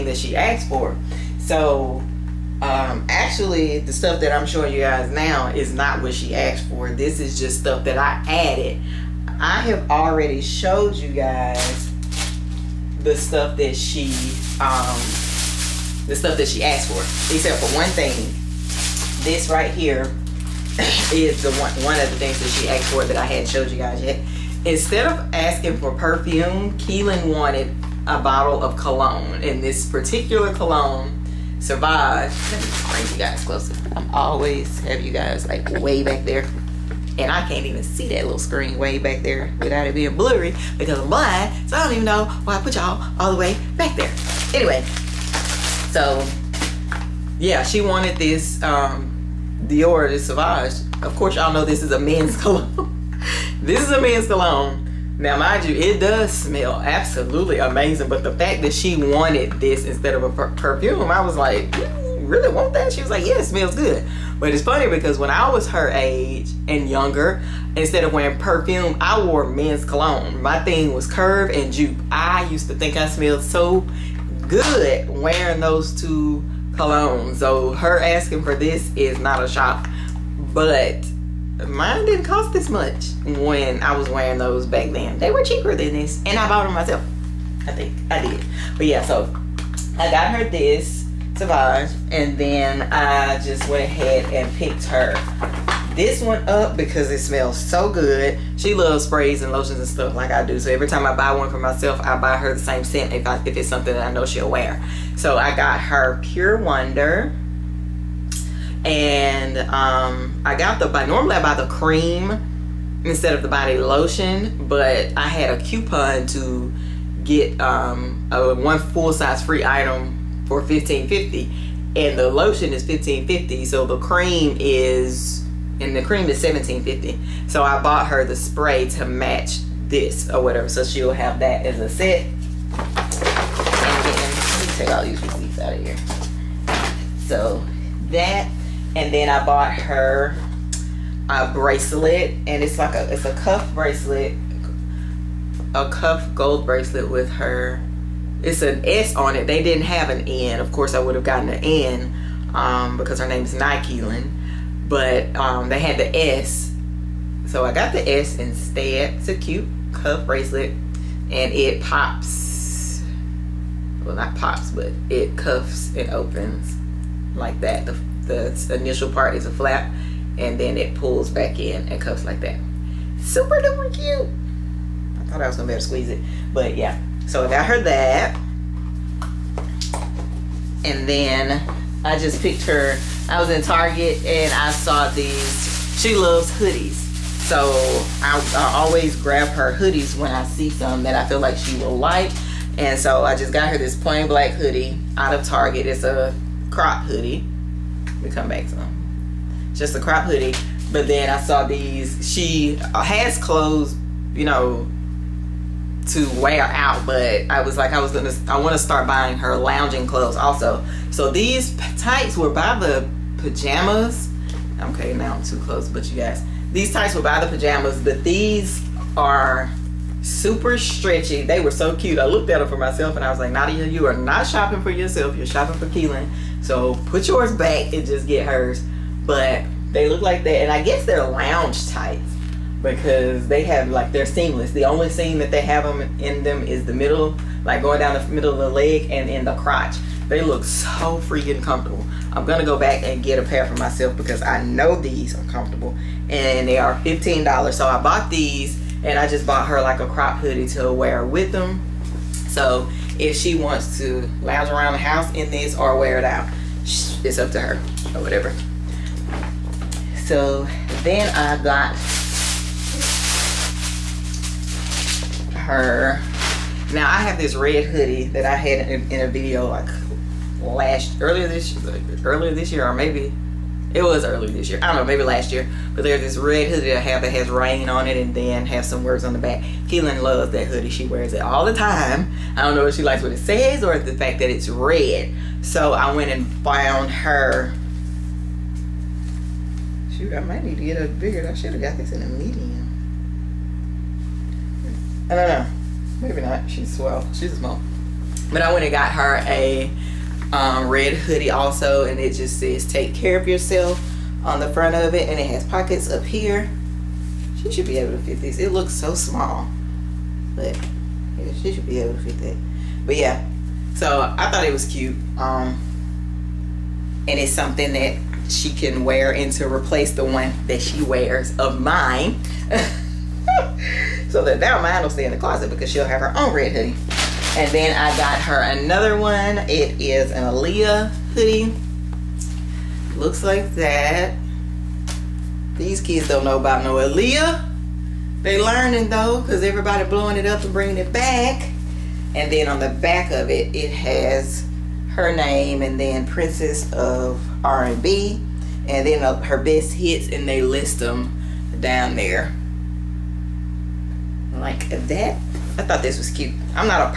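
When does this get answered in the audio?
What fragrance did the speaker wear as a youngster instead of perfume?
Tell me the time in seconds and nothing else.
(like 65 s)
71 s.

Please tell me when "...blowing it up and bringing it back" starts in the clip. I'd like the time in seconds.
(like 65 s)
340 s.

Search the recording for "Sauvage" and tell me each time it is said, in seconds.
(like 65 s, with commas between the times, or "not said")
31 s, 50 s.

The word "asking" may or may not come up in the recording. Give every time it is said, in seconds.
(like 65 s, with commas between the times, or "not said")
25 s, 78 s.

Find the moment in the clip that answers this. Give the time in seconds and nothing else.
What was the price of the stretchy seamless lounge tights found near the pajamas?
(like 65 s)
246 s.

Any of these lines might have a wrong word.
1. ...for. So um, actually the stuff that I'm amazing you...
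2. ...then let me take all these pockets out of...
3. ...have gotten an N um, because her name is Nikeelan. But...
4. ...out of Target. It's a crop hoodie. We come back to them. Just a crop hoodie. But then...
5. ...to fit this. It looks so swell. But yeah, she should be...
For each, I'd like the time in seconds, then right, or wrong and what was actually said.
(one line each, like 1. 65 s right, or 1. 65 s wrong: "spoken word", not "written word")
1. 0 s wrong: "showing", not "amazing"
2. 134 s wrong: "receipts", not "pockets"
3. 151 s right
4. 195 s right
5. 308 s wrong: "small", not "swell".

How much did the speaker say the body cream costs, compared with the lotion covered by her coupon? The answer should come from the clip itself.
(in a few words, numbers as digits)
$17.50.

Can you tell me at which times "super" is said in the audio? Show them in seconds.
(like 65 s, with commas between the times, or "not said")
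173 s, 220 s.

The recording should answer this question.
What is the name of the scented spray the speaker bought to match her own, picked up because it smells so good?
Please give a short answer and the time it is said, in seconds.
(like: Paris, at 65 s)
Pure Wonder, at 106 s.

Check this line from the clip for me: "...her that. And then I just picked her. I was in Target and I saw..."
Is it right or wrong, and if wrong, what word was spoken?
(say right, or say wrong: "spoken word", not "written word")
right.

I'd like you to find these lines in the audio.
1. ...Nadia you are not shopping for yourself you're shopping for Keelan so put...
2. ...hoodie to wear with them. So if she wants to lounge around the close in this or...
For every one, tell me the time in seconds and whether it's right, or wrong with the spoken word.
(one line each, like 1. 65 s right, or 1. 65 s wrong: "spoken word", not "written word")
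1. 223 s right
2. 250 s wrong: "house", not "close".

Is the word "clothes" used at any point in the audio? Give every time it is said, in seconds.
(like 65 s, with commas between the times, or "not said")
203 s, 210 s.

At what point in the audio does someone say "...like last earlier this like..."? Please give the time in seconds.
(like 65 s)
269 s.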